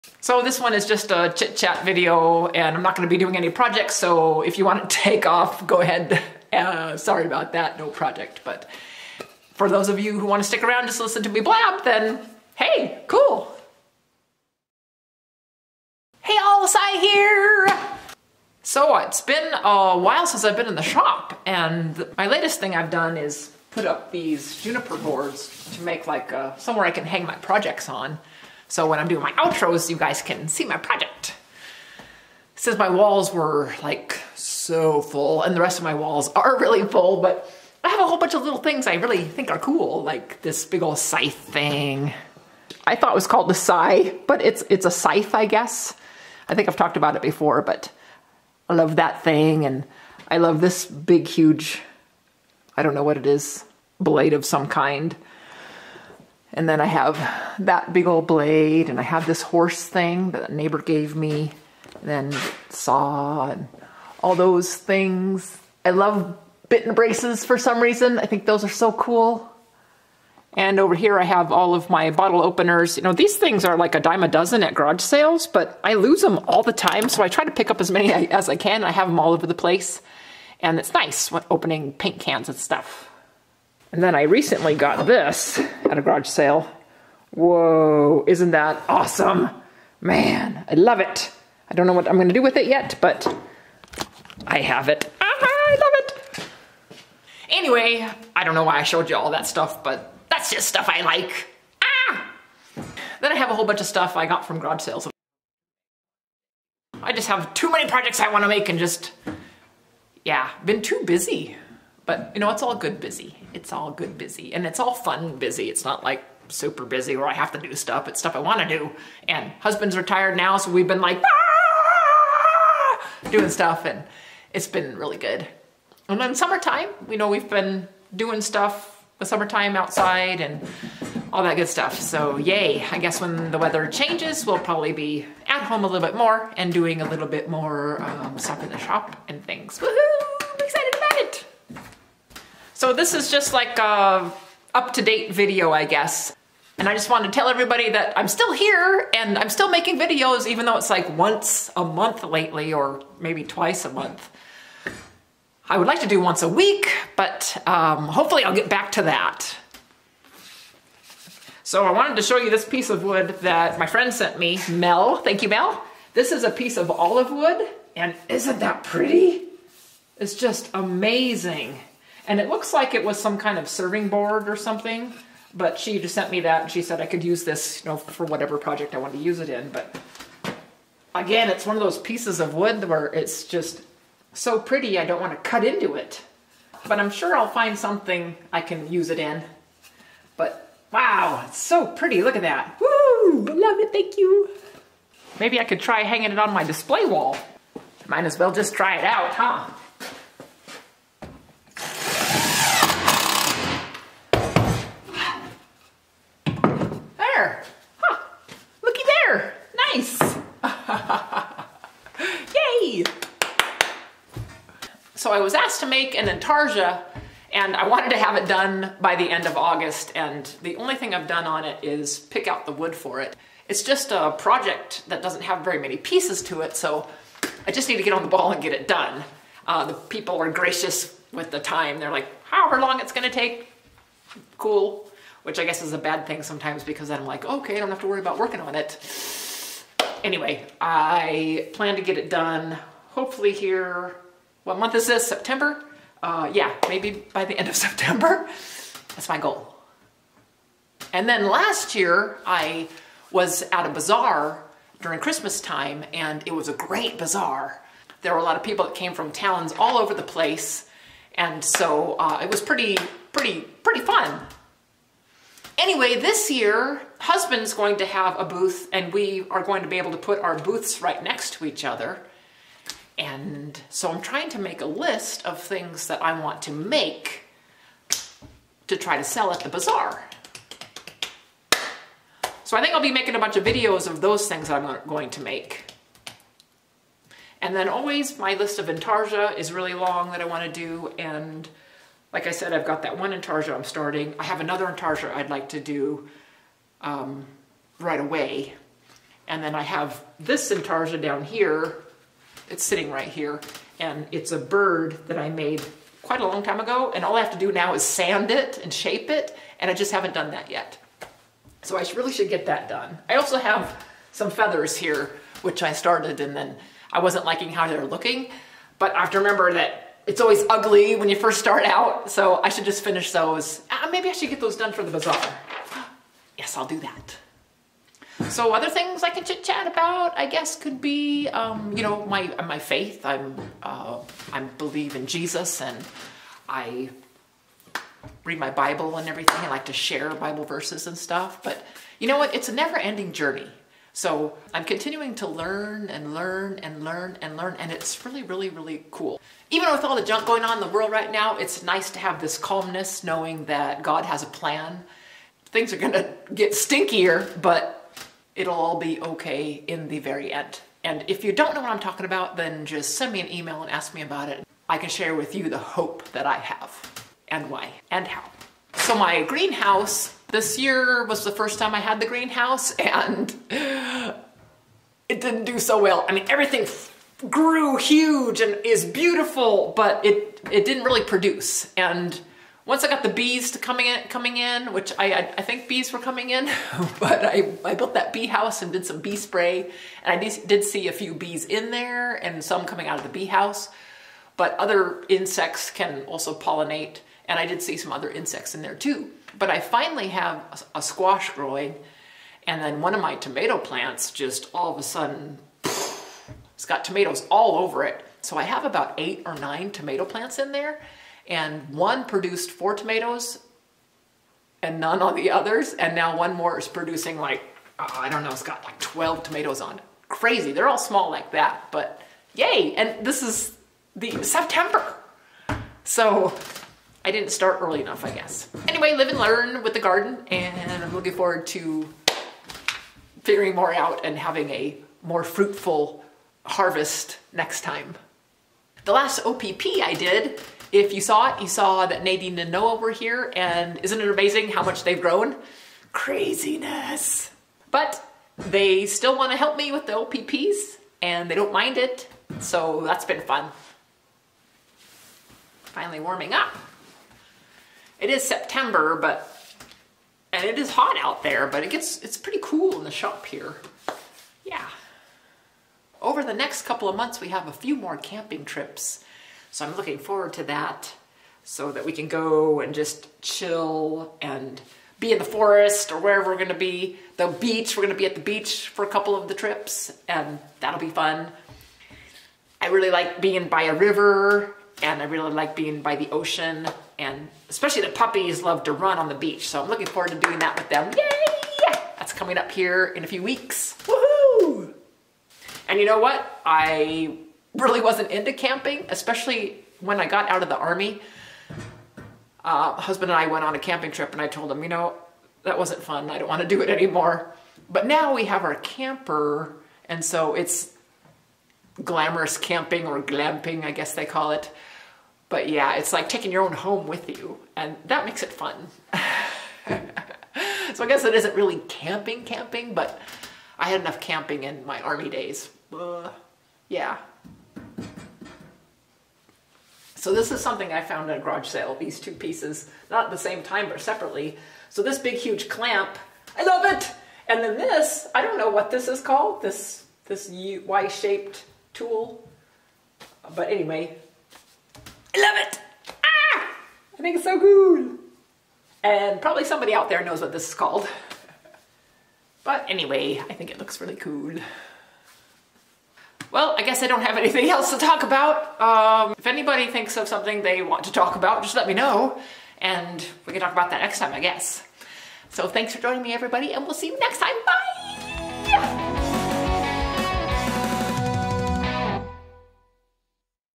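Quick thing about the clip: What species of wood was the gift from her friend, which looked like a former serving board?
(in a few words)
Olive wood.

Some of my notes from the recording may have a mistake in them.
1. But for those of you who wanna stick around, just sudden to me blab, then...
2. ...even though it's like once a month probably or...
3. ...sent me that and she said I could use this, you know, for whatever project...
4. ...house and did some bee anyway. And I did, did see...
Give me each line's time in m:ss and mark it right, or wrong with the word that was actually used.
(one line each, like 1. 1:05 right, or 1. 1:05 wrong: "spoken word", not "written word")
1. 0:08 wrong: "listen", not "sudden"
2. 2:30 wrong: "lately", not "probably"
3. 2:56 right
4. 6:28 wrong: "spray", not "anyway".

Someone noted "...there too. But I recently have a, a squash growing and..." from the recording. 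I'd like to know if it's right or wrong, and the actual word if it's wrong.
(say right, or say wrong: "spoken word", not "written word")
wrong: "finally", not "recently".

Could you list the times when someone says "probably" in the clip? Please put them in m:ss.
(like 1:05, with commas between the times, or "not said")
2:14, 9:09.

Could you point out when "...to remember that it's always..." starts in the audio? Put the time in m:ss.
5:19.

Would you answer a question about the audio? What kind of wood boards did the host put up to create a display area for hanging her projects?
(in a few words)
Juniper.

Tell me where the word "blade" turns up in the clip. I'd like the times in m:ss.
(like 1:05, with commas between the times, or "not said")
0:53, 0:58.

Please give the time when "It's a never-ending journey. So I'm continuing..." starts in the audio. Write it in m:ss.
5:42.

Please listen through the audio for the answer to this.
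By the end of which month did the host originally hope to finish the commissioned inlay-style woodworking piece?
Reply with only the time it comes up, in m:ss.
3:39.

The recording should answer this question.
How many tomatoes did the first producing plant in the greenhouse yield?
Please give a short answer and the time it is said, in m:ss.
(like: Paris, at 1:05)
4, at 6:52.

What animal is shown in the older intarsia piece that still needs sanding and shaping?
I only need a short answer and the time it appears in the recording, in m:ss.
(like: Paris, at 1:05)
A bird, at 5:04.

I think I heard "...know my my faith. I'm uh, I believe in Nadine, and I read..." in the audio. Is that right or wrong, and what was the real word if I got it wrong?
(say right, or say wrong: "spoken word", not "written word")
wrong: "Jesus", not "Nadine".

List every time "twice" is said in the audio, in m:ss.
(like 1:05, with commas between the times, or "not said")
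2:33.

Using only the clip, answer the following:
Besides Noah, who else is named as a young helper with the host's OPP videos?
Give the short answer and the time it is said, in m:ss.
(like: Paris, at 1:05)
Nadine, at 7:22.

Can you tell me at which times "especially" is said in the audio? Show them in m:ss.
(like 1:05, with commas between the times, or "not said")
8:07, 8:19.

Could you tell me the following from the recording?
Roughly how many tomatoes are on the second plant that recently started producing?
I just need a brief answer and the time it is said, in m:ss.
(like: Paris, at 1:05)
12, at 6:58.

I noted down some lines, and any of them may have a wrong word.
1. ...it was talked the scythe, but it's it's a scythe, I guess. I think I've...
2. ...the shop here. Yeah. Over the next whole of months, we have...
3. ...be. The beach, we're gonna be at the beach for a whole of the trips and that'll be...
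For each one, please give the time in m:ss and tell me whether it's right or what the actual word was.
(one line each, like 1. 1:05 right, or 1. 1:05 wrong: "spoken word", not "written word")
1. 0:43 wrong: "called", not "talked"
2. 7:43 wrong: "couple", not "whole"
3. 7:56 wrong: "couple", not "whole".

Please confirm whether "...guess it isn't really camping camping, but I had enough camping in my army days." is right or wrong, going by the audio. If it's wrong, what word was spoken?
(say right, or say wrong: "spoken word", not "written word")
right.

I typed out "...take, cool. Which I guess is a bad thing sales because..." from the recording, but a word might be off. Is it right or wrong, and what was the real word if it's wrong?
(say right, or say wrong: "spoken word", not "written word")
wrong: "sometimes", not "sales".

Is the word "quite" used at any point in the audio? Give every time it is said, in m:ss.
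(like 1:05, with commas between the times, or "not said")
5:06.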